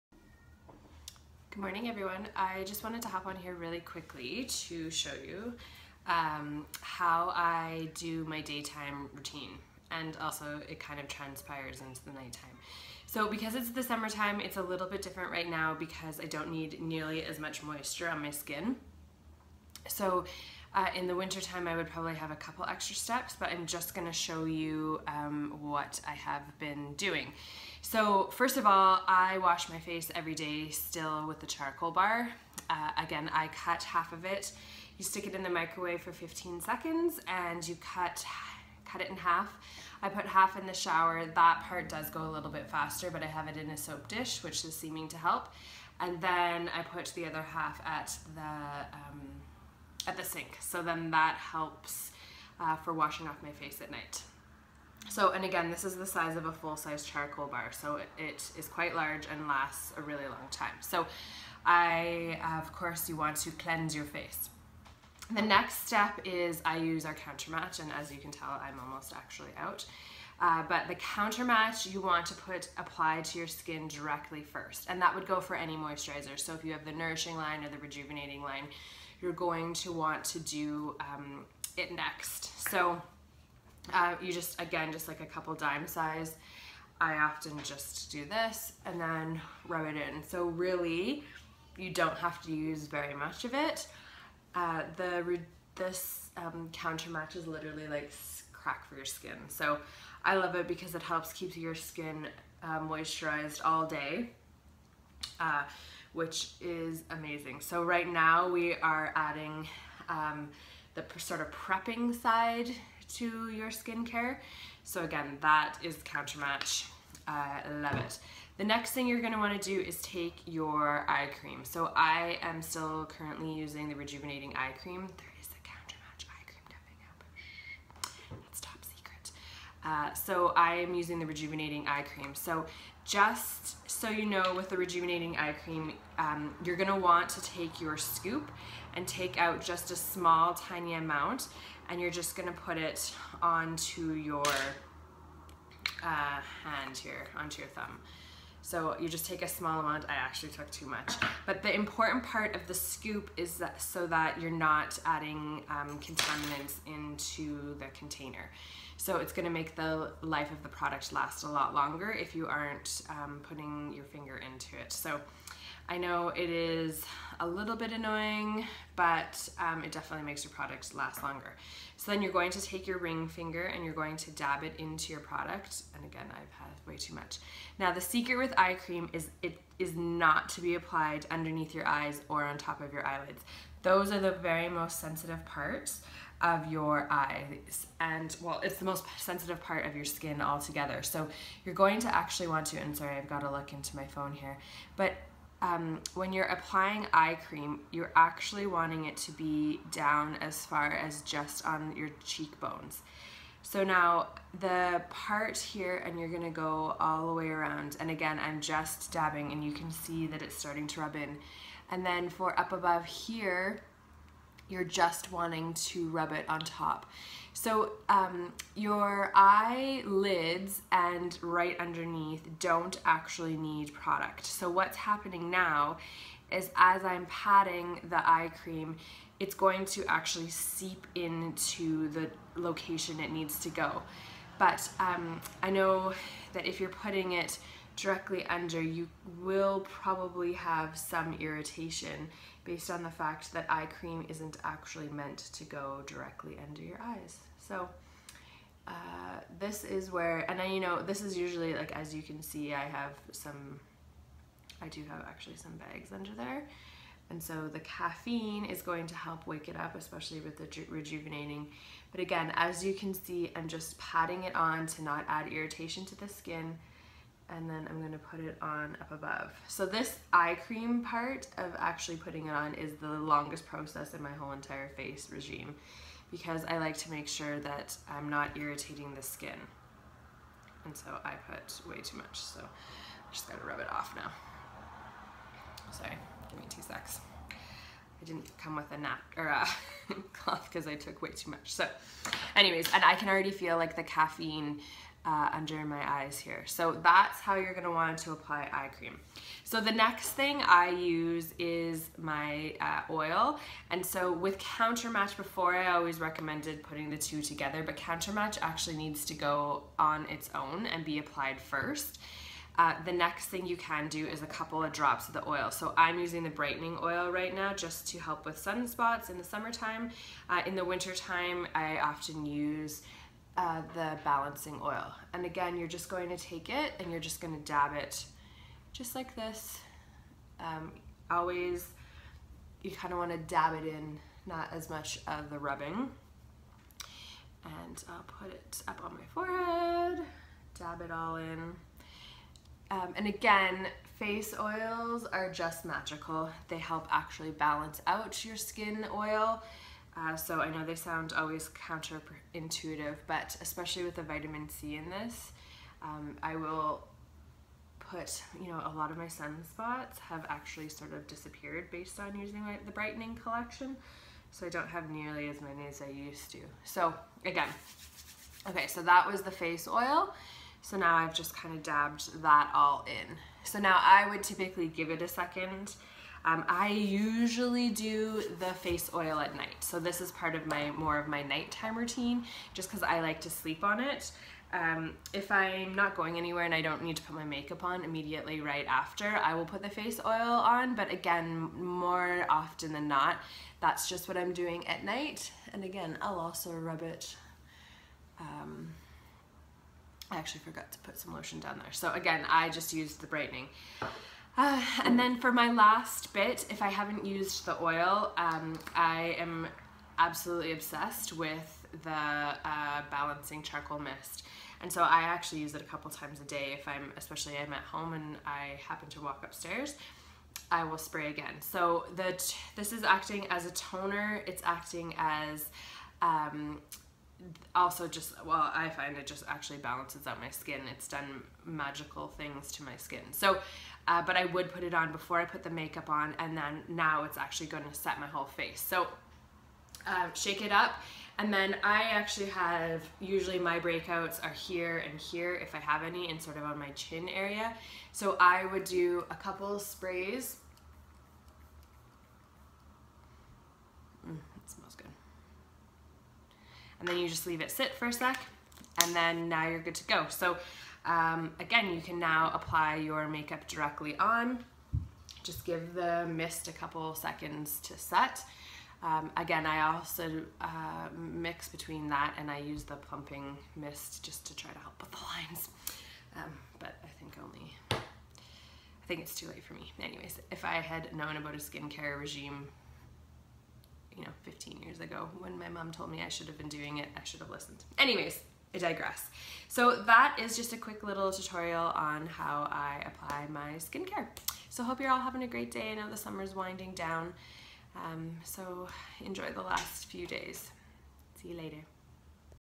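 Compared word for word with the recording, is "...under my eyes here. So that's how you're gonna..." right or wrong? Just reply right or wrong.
right.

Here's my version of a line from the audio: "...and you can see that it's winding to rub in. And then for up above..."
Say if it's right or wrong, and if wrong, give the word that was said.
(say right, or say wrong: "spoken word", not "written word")
wrong: "starting", not "winding".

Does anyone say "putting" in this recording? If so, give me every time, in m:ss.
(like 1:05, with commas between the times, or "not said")
2:43, 3:56, 4:32, 5:06.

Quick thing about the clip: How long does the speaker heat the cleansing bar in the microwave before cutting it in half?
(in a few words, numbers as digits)
15 seconds.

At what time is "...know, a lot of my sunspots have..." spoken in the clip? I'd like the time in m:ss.
5:58.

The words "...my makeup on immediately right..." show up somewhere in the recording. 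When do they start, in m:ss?
6:27.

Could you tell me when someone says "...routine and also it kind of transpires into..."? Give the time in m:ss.
0:09.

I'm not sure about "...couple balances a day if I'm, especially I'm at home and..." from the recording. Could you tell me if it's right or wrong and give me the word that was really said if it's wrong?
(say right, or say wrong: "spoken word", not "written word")
wrong: "times", not "balances".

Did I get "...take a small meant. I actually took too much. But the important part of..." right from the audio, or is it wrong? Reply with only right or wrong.
wrong.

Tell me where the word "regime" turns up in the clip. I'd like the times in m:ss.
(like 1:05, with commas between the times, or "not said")
4:35, 8:02.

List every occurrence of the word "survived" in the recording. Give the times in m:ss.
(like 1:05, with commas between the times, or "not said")
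not said.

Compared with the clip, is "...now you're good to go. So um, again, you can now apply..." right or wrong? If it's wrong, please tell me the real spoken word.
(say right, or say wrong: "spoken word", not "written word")
right.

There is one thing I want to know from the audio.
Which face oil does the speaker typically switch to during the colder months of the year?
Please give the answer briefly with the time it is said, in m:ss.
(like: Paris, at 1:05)
balancing oil, at 5:24.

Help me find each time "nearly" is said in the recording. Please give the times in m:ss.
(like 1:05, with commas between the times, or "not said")
0:16, 6:05.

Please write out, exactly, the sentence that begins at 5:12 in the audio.
Uh, the next thing you can do is a couple of drops of the oil.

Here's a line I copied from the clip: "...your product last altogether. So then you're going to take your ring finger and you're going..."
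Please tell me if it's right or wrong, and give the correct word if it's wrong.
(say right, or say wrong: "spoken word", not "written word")
wrong: "longer", not "altogether".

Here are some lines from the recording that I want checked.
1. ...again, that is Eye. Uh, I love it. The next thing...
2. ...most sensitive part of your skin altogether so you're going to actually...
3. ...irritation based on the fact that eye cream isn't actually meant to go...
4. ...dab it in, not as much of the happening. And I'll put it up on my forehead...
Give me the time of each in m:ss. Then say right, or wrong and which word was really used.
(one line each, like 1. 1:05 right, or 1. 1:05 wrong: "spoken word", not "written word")
1. 1:55 wrong: "Countermatch", not "Eye"
2. 3:08 right
3. 4:01 right
4. 5:33 wrong: "rubbing", not "happening".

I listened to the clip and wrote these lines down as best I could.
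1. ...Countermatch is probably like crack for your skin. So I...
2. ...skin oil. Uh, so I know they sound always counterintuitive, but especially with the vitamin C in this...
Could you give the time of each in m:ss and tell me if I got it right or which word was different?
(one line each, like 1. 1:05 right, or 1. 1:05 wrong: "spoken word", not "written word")
1. 1:36 wrong: "literally", not "probably"
2. 5:48 right.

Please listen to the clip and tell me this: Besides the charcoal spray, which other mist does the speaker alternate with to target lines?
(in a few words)
plumping mist.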